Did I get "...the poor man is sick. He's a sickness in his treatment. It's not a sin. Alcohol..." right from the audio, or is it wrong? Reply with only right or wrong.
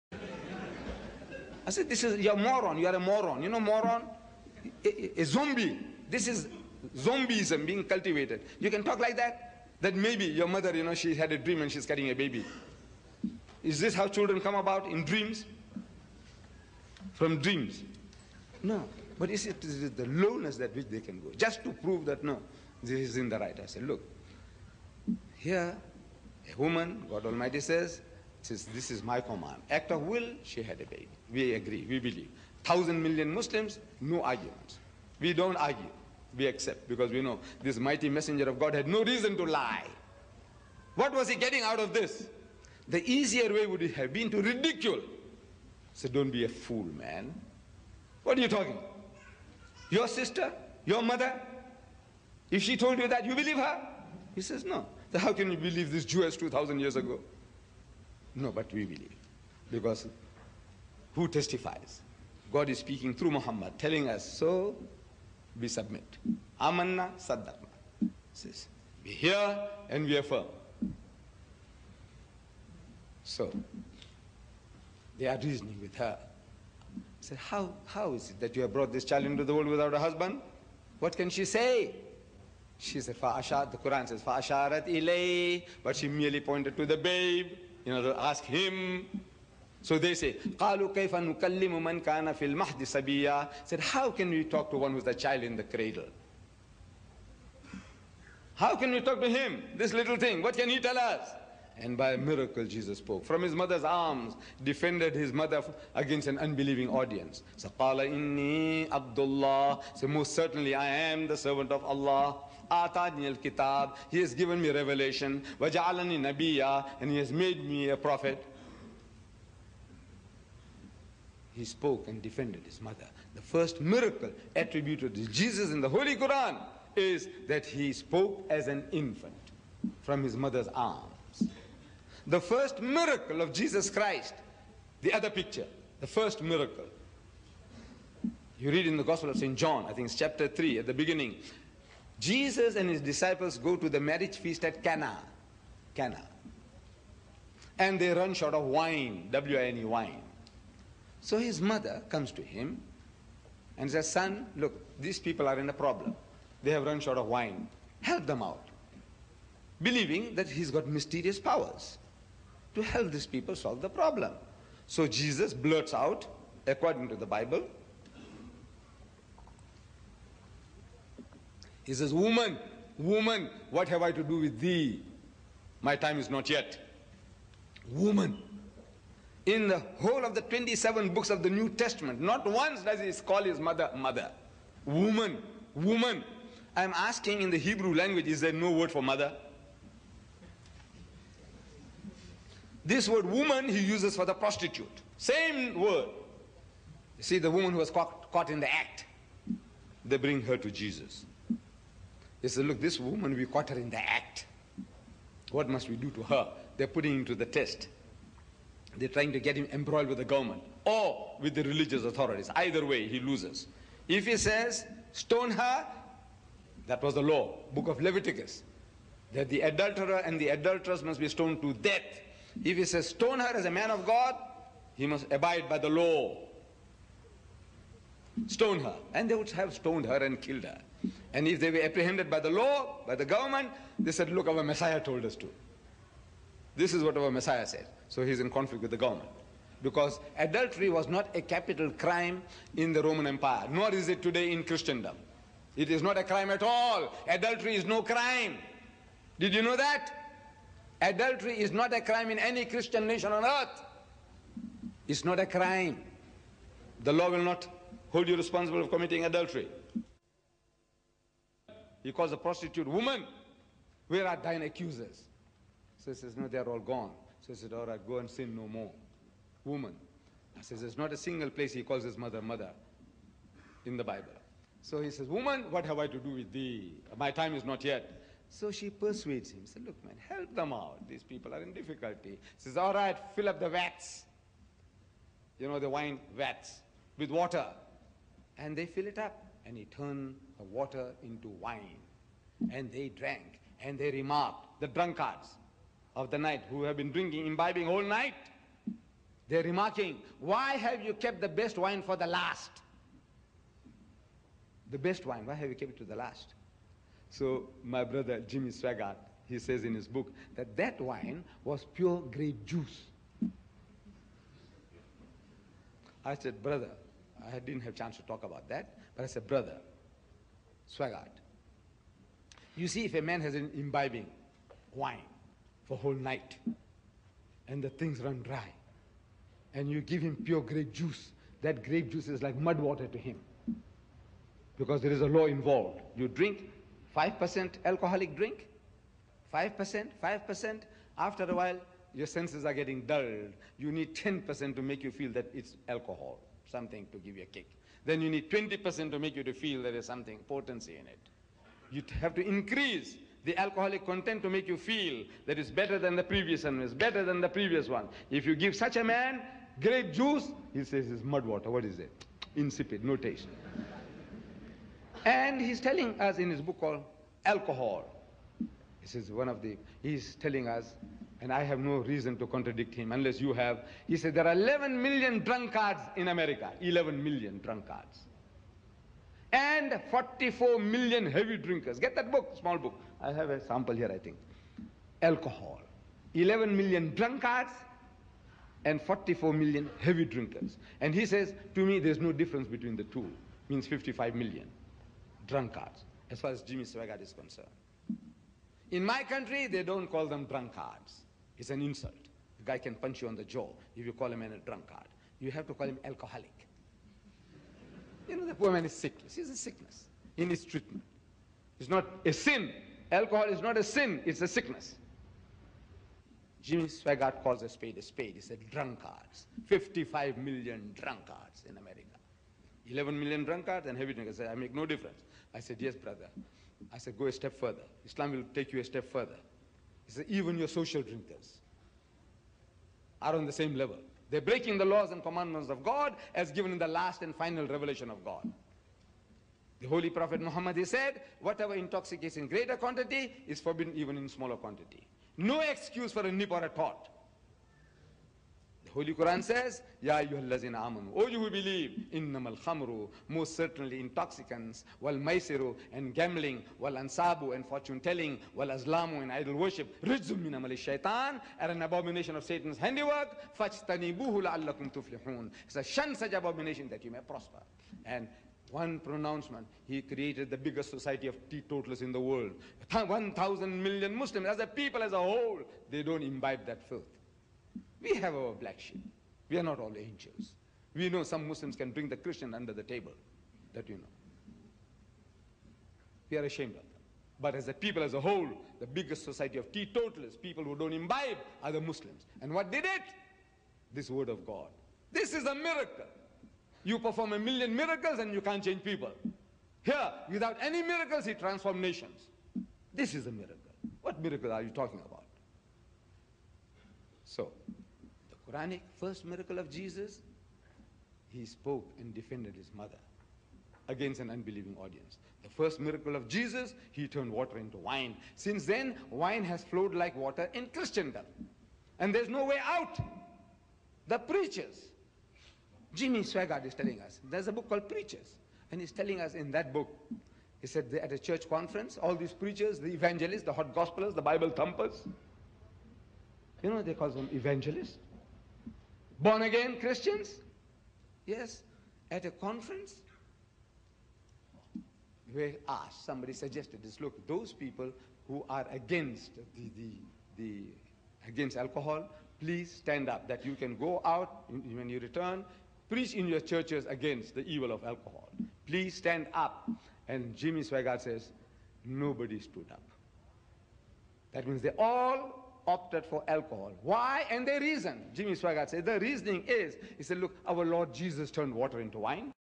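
right.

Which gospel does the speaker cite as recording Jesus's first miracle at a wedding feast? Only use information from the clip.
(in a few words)
Gospel of St. John.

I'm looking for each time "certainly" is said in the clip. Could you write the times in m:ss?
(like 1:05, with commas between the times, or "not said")
1:50, 7:33.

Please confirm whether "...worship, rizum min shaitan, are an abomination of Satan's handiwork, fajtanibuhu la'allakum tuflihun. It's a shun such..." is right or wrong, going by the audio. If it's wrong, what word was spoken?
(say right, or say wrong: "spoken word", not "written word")
right.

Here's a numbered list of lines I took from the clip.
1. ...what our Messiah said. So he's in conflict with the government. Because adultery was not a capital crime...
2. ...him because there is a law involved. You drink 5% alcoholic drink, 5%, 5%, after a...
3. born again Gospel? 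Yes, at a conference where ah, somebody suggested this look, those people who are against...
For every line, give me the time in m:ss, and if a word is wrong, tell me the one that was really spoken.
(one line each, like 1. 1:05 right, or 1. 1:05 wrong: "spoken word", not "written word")
1. 3:57 right
2. 5:33 right
3. 8:59 wrong: "Christians", not "Gospel".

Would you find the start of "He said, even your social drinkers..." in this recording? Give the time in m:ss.
7:10.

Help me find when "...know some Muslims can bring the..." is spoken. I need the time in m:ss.
8:01.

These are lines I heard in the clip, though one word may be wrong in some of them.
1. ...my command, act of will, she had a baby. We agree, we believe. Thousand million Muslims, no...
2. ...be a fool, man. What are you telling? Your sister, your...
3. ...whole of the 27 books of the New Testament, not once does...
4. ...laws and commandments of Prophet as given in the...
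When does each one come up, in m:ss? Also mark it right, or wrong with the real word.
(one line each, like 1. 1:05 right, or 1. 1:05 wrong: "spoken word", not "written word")
1. 0:29 right
2. 0:46 wrong: "talking", not "telling"
3. 2:59 right
4. 7:14 wrong: "God", not "Prophet".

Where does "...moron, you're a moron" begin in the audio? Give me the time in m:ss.
0:02.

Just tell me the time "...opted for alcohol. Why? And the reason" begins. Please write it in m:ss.
9:25.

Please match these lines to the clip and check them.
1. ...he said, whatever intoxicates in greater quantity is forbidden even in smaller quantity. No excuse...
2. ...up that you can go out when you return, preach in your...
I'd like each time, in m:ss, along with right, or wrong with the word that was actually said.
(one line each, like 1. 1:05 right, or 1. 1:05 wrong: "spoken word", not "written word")
1. 7:20 right
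2. 9:13 right.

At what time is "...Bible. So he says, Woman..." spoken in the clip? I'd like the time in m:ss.
4:34.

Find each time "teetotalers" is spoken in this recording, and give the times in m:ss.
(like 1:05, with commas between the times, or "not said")
7:51, 8:09.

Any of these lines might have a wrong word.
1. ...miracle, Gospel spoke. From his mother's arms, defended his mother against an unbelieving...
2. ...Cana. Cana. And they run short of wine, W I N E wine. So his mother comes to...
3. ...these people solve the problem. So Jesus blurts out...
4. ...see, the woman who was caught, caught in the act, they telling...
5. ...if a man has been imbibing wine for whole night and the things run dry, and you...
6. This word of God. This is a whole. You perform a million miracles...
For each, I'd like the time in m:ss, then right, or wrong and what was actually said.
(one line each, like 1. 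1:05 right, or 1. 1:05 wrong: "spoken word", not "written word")
1. 1:42 wrong: "Jesus", not "Gospel"
2. 2:24 right
3. 2:43 right
4. 3:17 wrong: "bring", not "telling"
5. 5:23 right
6. 8:13 wrong: "miracle", not "whole".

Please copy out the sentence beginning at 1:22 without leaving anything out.
She said, the Quran says, Fa'asharat ilay, but she merely pointed to the babe you know, ask him.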